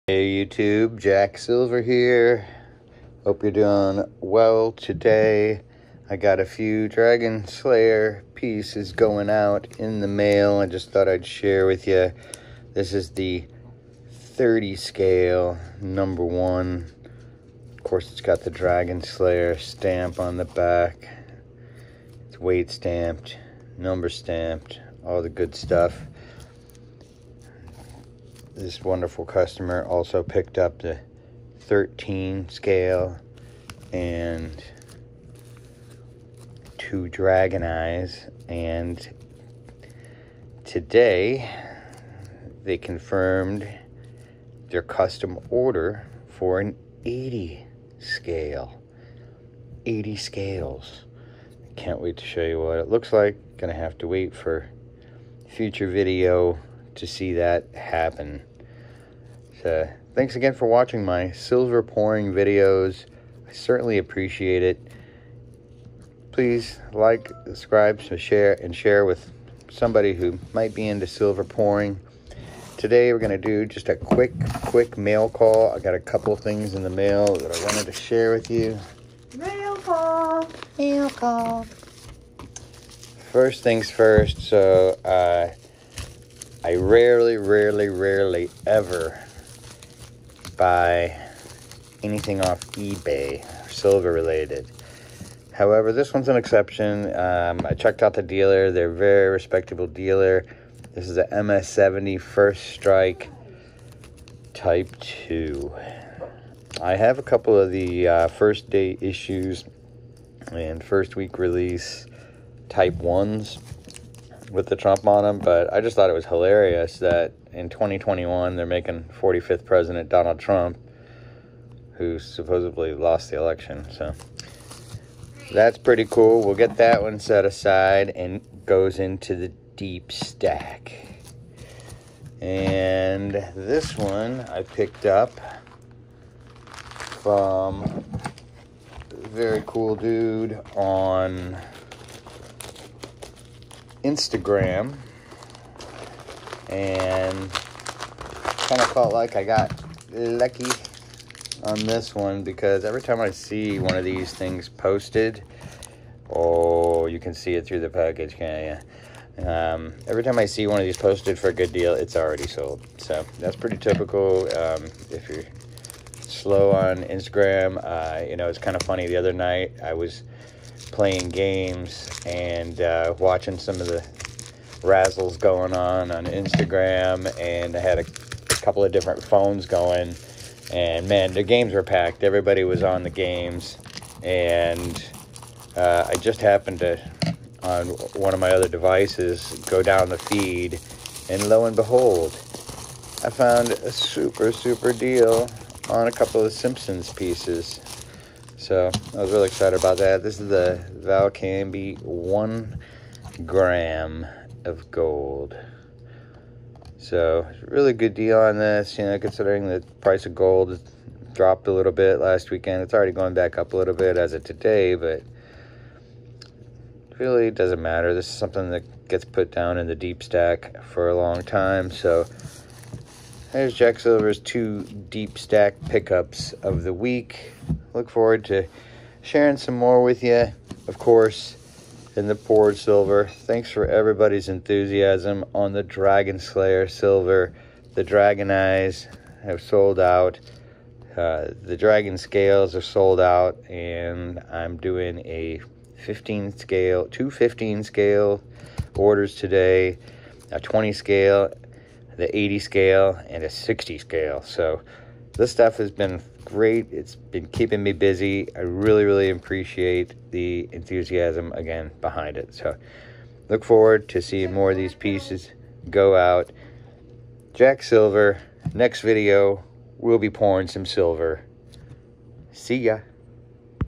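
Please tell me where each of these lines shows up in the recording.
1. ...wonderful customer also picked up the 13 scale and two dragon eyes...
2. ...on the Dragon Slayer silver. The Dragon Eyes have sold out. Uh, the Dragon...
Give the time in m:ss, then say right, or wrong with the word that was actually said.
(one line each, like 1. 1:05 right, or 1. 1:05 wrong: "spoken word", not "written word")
1. 0:28 right
2. 3:55 right.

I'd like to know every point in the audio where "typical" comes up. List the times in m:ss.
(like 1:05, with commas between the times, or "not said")
2:43.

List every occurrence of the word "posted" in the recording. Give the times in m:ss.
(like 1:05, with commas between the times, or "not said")
2:34, 2:40.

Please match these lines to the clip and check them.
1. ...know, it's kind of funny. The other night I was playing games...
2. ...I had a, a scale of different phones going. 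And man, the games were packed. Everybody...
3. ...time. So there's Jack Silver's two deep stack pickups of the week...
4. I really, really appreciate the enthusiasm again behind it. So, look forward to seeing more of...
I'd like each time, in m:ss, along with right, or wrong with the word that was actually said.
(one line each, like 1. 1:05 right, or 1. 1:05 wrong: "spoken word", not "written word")
1. 2:48 right
2. 2:57 wrong: "couple", not "scale"
3. 3:41 right
4. 4:18 right.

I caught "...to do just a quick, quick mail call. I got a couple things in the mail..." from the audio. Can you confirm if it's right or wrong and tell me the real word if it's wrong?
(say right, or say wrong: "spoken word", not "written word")
right.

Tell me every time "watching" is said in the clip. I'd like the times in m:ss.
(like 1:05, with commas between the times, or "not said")
1:00, 2:53.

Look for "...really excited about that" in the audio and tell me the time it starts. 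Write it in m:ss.
3:19.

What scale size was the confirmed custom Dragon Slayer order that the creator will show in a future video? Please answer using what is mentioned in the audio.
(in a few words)
80 scale.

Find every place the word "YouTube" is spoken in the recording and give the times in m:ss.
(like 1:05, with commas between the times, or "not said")
0:00.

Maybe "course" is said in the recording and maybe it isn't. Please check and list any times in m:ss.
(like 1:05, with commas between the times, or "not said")
0:17, 3:50.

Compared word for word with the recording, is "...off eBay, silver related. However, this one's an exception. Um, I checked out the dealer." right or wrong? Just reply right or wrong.
right.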